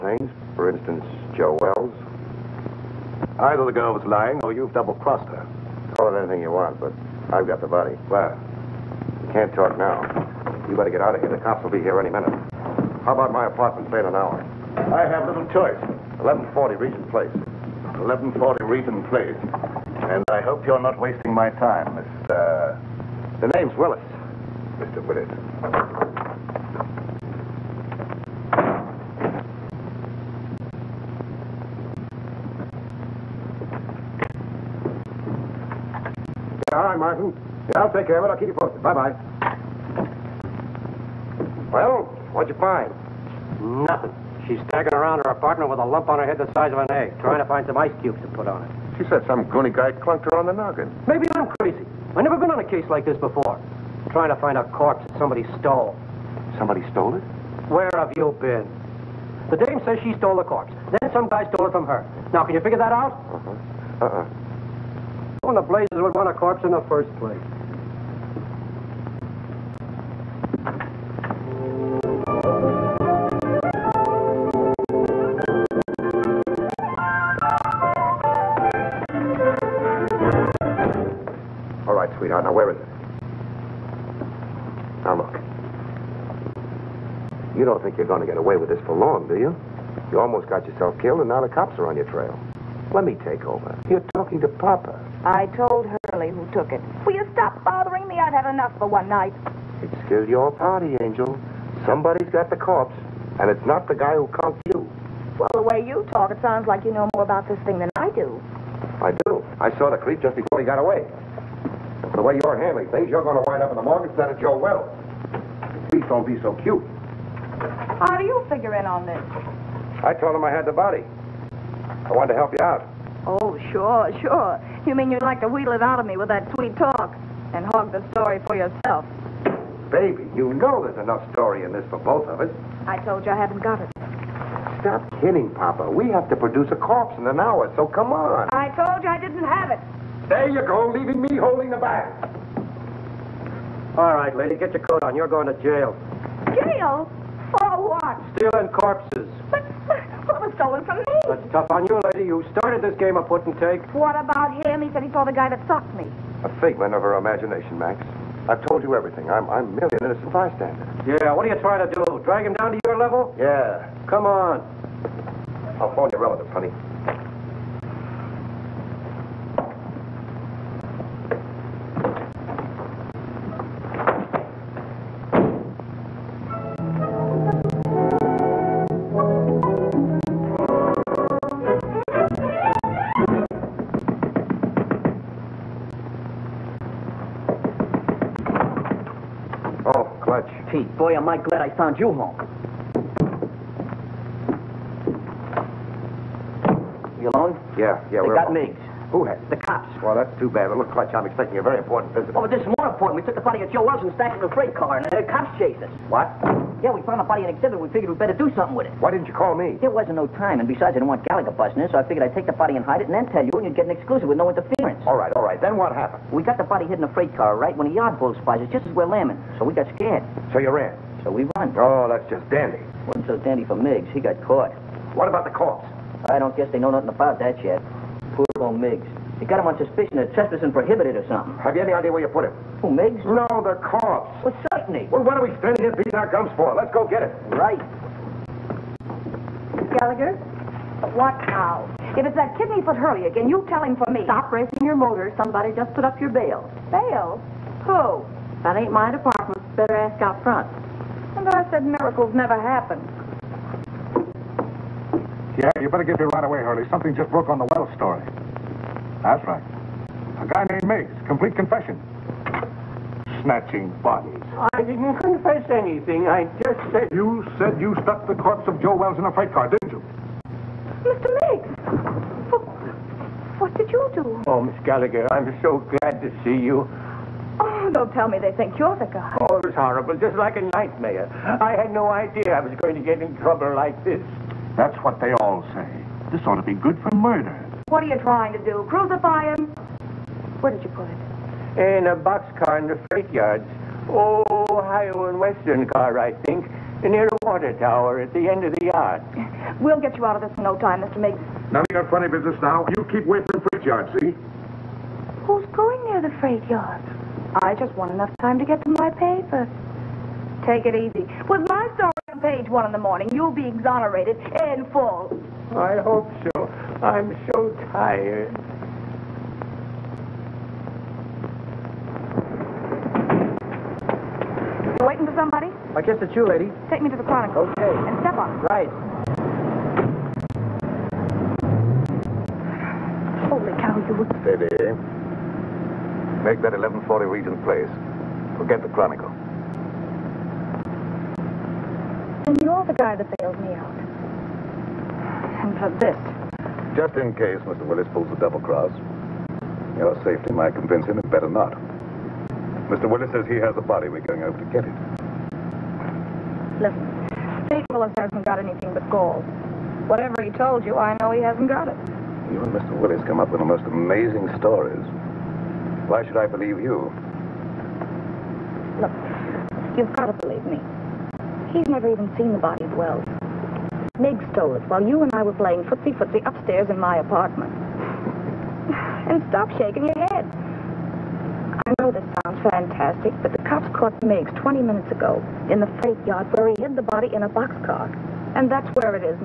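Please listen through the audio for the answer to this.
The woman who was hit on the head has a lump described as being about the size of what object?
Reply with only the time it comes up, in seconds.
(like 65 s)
46 s.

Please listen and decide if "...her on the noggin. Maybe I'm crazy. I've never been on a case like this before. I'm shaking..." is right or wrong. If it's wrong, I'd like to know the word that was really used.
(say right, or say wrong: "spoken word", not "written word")
wrong: "trying", not "shaking".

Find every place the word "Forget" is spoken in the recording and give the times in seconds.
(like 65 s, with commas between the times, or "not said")
338 s.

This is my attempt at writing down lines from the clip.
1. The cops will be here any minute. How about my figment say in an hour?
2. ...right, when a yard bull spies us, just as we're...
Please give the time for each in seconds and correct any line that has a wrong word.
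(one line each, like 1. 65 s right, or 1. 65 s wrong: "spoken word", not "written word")
1. 11 s wrong: "apartment", not "figment"
2. 217 s right.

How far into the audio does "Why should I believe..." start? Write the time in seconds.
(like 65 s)
366 s.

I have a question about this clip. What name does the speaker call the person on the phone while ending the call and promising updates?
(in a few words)
Martin.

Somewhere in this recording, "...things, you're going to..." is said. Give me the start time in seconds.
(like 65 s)
112 s.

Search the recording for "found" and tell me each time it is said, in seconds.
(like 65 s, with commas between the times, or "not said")
191 s, 207 s.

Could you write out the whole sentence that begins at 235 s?
Well, what are we standing here beating our gums for?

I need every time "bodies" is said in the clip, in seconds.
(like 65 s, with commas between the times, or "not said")
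264 s.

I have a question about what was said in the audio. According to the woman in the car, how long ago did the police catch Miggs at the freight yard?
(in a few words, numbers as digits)
20 minutes.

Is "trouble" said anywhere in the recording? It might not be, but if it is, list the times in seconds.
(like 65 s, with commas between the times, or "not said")
283 s.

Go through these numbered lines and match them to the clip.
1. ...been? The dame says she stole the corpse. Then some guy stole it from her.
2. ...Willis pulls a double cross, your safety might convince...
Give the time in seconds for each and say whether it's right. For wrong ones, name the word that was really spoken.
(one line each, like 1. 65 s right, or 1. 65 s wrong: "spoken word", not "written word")
1. 58 s right
2. 347 s right.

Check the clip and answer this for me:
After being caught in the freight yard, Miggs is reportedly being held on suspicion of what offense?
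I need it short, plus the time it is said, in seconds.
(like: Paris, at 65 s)
Trespassing, at 230 s.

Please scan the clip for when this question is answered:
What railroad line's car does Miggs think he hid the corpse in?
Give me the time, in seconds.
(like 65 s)
294 s.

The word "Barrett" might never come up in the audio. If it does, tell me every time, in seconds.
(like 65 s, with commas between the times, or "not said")
not said.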